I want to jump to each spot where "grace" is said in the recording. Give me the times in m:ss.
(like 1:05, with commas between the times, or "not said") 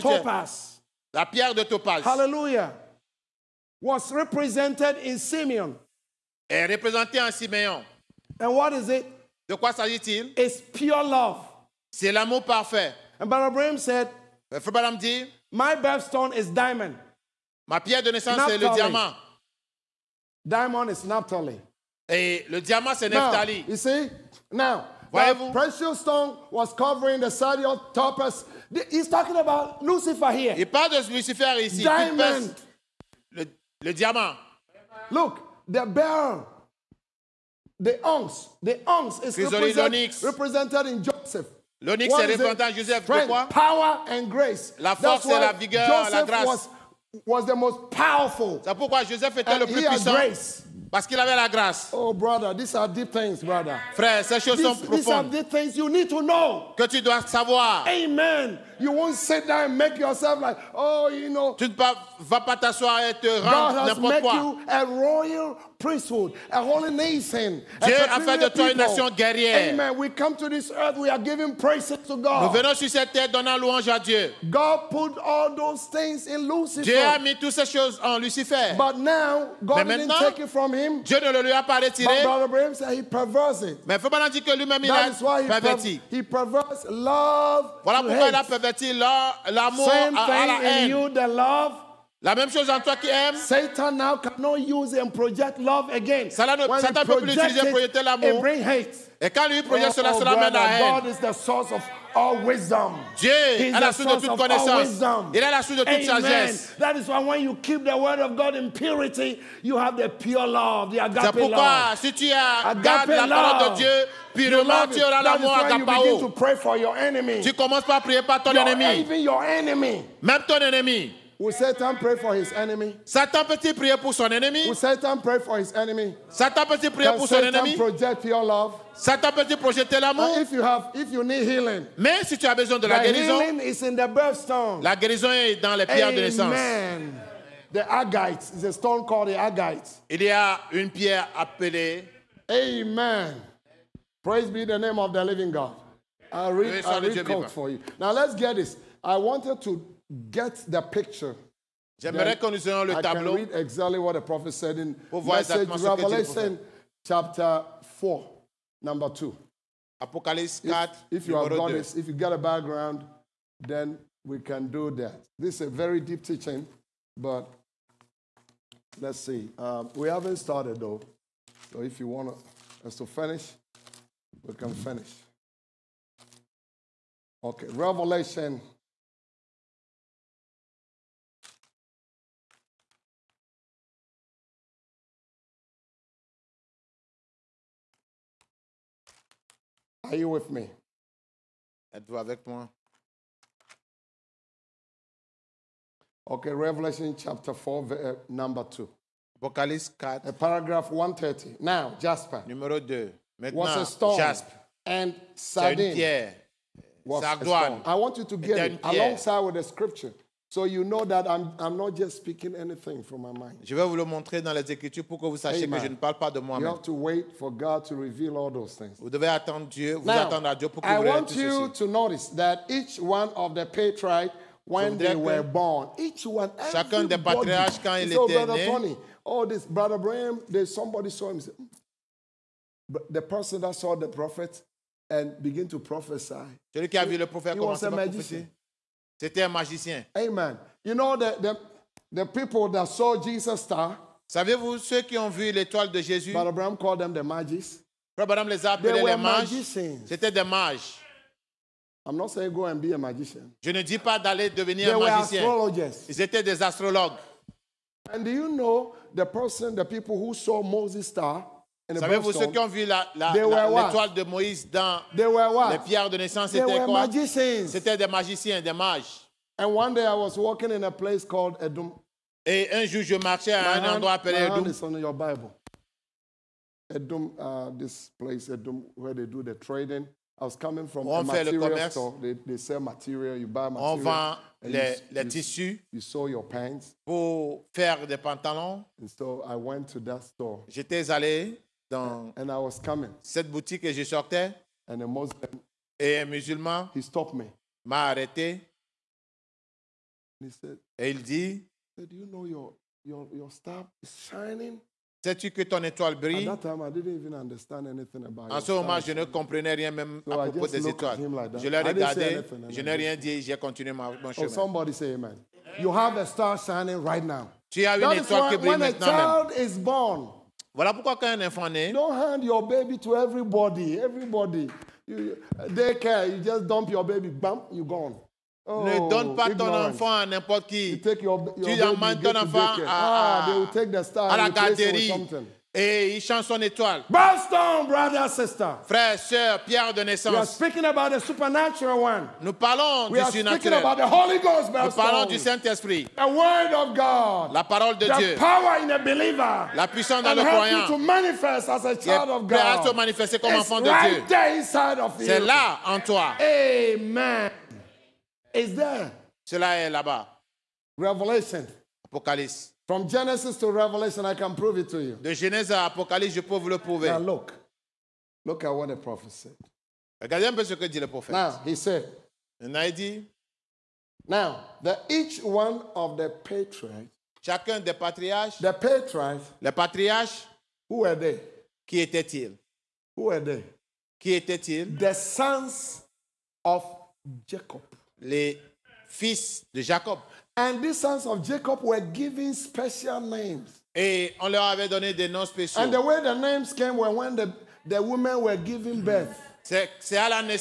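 0:44, 0:50.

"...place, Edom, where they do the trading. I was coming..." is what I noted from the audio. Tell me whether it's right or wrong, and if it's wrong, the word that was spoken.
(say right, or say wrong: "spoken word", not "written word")
right.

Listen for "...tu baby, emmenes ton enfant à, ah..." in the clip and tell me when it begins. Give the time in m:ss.
5:31.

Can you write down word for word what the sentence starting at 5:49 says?
La puissance dans And le croyant.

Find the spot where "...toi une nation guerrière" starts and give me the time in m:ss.
1:08.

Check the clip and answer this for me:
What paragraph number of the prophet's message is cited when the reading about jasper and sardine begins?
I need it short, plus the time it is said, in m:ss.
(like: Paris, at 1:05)
130, at 3:20.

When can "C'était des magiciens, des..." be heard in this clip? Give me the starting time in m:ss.
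4:27.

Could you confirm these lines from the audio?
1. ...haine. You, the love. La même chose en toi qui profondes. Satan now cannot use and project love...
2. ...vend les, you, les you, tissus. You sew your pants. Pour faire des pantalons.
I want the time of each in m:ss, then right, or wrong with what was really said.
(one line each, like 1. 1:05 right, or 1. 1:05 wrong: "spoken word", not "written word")
1. 1:30 wrong: "aimes", not "profondes"
2. 4:44 right.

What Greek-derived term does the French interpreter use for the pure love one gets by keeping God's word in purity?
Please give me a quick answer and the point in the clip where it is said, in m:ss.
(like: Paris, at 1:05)
agapao, at 1:55.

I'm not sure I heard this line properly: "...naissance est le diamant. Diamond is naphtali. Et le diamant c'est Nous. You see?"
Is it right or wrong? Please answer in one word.
wrong.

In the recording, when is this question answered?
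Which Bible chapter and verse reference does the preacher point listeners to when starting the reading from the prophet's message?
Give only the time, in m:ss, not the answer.
2:35.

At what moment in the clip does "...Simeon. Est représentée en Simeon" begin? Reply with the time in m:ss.
0:05.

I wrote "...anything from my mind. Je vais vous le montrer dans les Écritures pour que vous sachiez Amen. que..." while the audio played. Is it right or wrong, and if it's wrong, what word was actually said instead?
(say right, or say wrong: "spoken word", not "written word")
right.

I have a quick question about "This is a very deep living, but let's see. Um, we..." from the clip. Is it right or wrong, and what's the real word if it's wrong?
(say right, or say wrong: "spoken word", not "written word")
wrong: "teaching", not "living".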